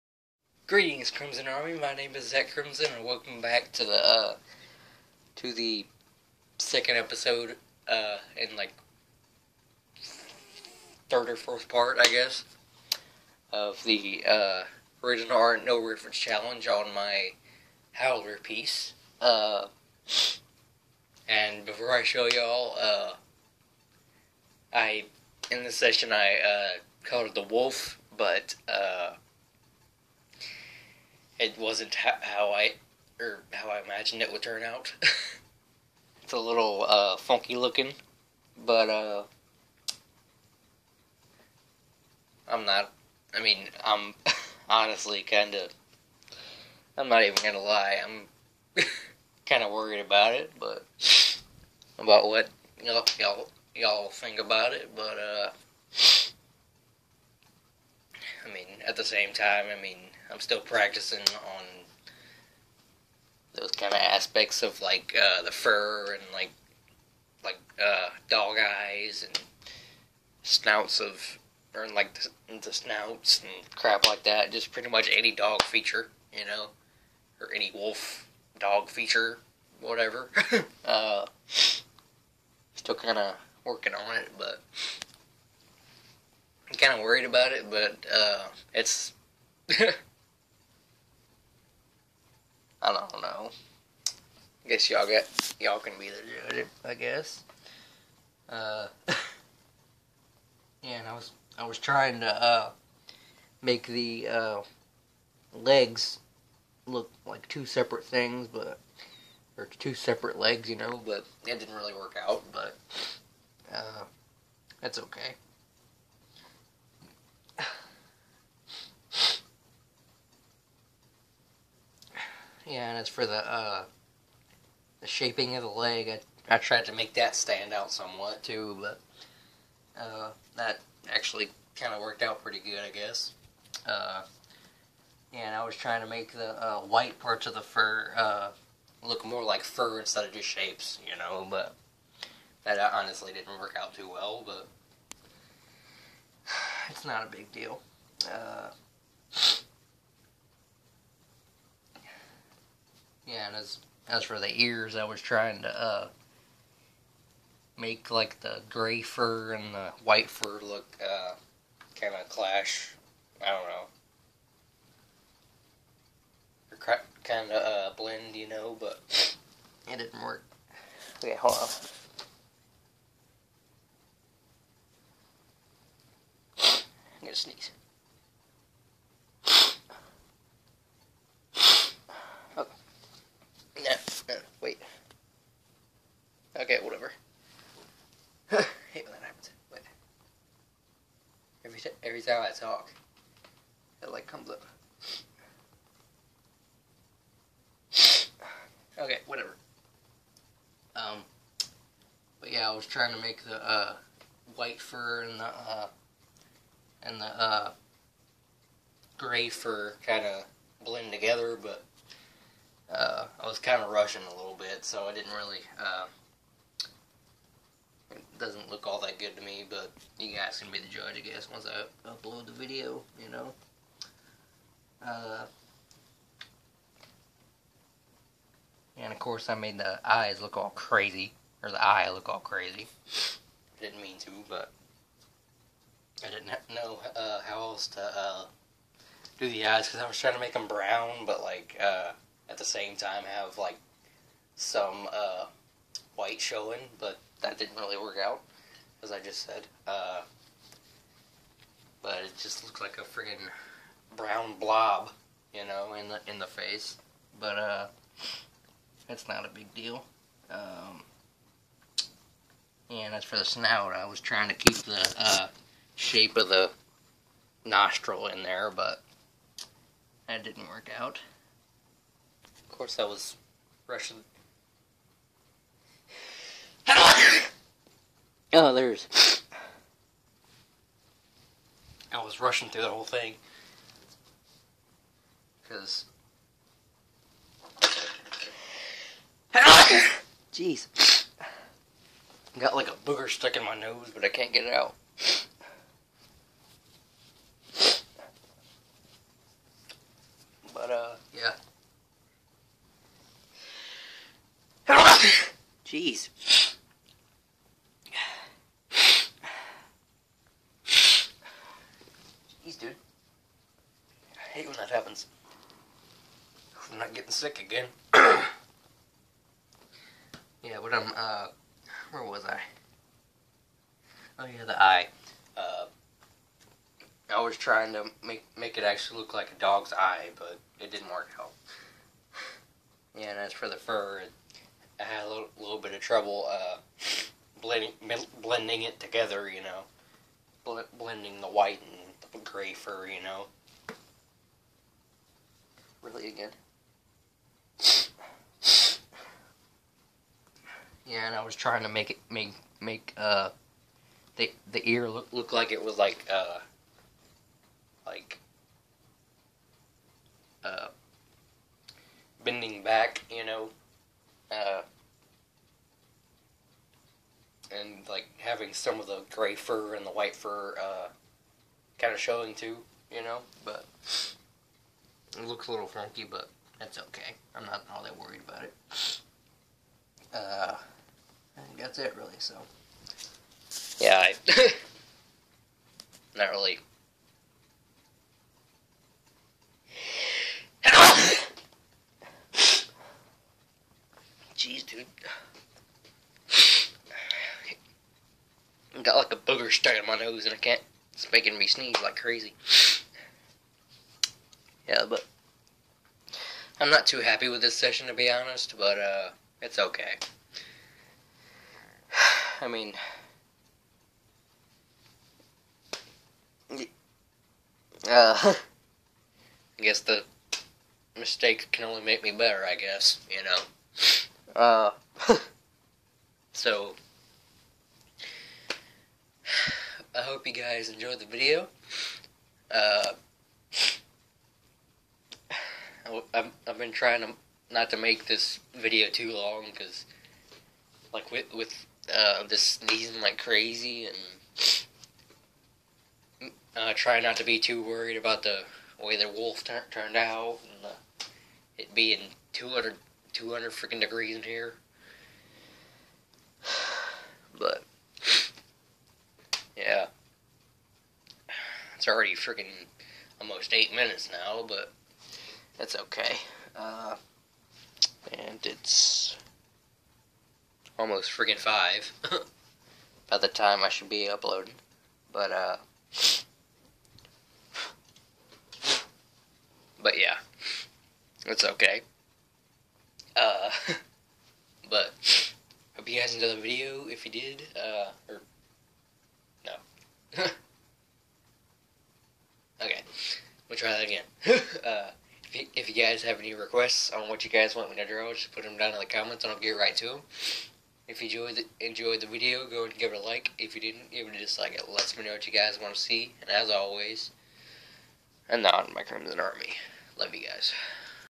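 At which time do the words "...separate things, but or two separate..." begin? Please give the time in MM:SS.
01:47.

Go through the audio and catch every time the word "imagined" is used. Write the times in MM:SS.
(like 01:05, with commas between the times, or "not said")
00:33.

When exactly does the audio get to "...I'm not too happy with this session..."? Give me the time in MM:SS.
06:46.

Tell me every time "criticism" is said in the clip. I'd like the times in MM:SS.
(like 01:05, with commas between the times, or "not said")
not said.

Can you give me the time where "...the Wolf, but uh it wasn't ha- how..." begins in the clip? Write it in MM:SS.
00:27.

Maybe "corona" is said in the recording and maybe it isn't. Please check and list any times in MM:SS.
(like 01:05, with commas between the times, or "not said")
not said.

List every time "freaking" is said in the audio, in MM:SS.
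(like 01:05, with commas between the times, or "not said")
07:33, 07:42.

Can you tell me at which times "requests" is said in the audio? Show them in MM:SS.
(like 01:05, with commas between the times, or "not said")
08:16.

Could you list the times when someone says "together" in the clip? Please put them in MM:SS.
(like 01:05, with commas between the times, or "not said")
03:31, 05:38.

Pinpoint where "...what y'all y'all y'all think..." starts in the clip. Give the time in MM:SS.
00:52.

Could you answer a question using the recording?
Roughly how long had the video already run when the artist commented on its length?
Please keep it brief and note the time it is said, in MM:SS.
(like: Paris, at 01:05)
almost 8 minutes, at 07:43.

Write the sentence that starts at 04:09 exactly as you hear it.
Uh, but it just looked like a friggin' brown blob, you know, in the in the face.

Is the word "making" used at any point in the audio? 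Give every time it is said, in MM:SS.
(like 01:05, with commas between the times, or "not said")
06:41.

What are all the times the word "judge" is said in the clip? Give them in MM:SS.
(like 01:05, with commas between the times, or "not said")
01:36, 03:40.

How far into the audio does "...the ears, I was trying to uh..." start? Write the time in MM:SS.
02:34.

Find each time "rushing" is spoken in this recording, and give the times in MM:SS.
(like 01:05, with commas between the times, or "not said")
03:33, 04:33, 04:42.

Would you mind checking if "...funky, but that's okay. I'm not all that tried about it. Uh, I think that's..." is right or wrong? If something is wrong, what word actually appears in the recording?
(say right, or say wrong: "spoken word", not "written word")
wrong: "worried", not "tried".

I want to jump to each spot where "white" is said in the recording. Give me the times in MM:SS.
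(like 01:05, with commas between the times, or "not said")
02:16, 02:40, 03:24, 04:06, 05:41, 06:10.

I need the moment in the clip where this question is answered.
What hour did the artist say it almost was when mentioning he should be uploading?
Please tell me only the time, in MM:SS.
07:51.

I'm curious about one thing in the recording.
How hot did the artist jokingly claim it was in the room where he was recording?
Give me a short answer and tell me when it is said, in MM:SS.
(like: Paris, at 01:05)
200 degrees, at 07:33.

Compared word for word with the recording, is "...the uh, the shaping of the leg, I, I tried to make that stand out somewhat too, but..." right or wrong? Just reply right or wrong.
right.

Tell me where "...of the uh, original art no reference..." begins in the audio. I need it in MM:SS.
00:13.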